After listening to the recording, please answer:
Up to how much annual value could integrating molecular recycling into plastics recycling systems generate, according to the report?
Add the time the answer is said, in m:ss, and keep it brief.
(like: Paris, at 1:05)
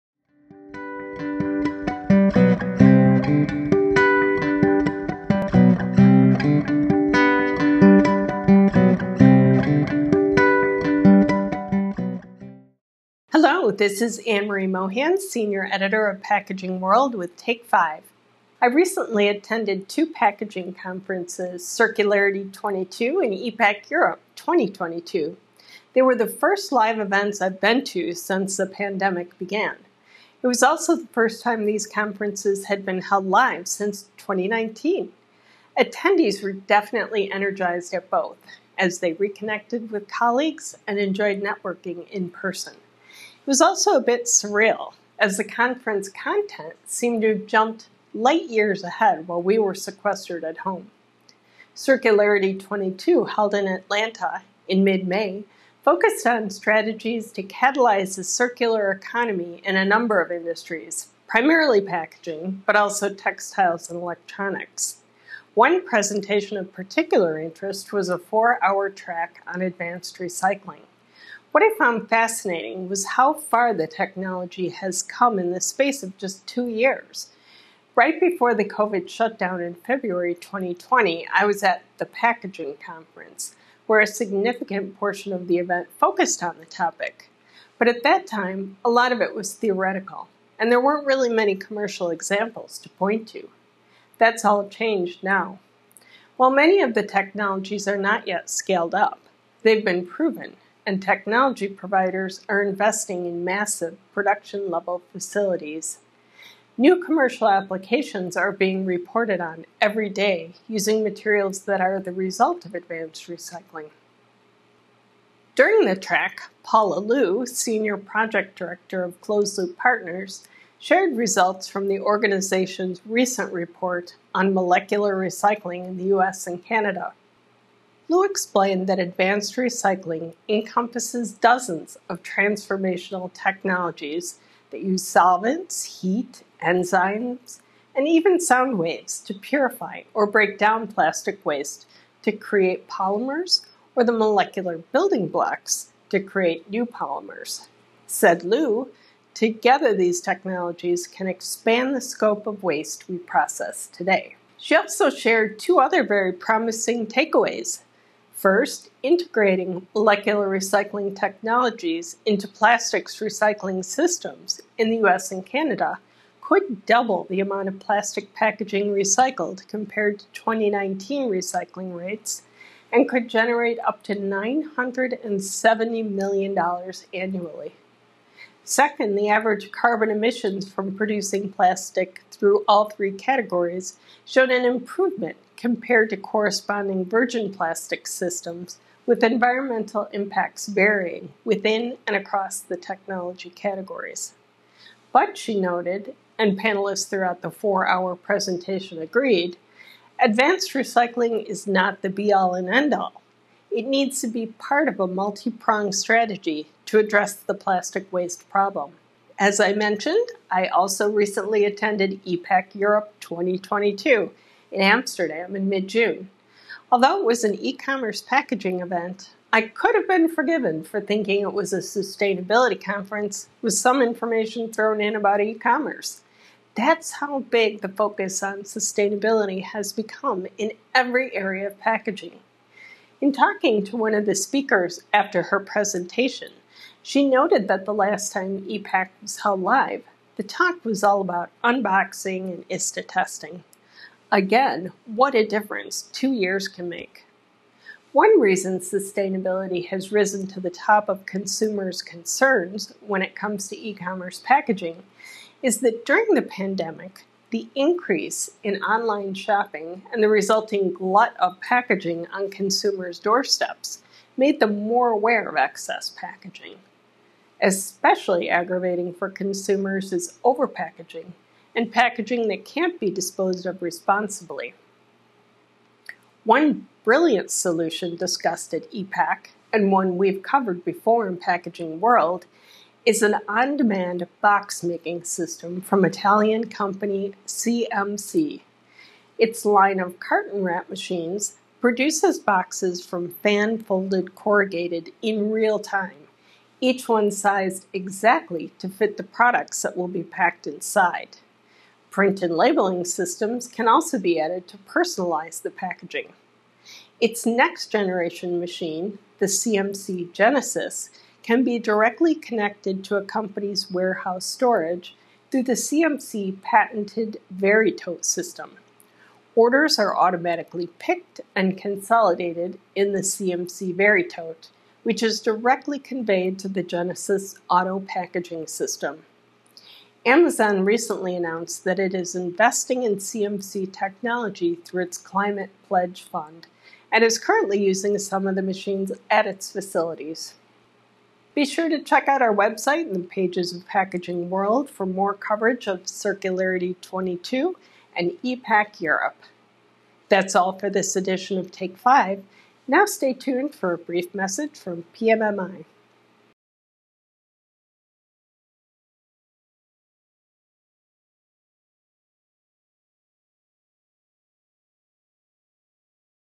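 $970 million, at 2:54.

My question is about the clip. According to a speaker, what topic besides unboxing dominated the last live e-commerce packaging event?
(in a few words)
ISTA testing.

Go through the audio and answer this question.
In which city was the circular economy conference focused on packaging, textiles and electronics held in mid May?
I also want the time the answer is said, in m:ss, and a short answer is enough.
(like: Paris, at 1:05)
Atlanta, at 0:53.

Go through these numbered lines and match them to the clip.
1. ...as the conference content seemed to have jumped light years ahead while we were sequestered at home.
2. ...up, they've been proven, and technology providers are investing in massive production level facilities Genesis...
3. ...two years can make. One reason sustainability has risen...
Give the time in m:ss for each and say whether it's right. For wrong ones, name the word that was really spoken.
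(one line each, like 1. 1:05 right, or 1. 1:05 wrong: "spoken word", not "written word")
1. 0:45 right
2. 1:38 wrong: "New", not "Genesis"
3. 4:06 right.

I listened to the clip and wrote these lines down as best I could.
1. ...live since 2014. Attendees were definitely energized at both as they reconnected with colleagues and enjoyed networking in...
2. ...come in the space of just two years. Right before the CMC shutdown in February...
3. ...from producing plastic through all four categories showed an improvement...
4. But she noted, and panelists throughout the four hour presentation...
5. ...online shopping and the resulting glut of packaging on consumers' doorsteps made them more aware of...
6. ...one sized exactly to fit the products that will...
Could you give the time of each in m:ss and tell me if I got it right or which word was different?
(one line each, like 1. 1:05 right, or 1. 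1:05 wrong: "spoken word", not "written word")
1. 0:33 wrong: "2019", not "2014"
2. 1:15 wrong: "COVID", not "CMC"
3. 3:00 wrong: "three", not "four"
4. 3:15 right
5. 4:18 right
6. 4:57 right.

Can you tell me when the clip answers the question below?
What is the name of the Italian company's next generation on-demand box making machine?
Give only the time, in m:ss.
5:09.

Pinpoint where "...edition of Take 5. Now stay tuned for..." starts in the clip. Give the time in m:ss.
5:51.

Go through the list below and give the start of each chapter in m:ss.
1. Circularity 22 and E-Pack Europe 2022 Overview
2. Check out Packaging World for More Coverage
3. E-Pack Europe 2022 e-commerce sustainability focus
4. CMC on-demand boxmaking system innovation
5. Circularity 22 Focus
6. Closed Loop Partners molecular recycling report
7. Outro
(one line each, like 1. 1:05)
1. 0:13
2. 5:41
3. 3:29
4. 4:36
5. 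0:51
6. 1:54
7. 5:56.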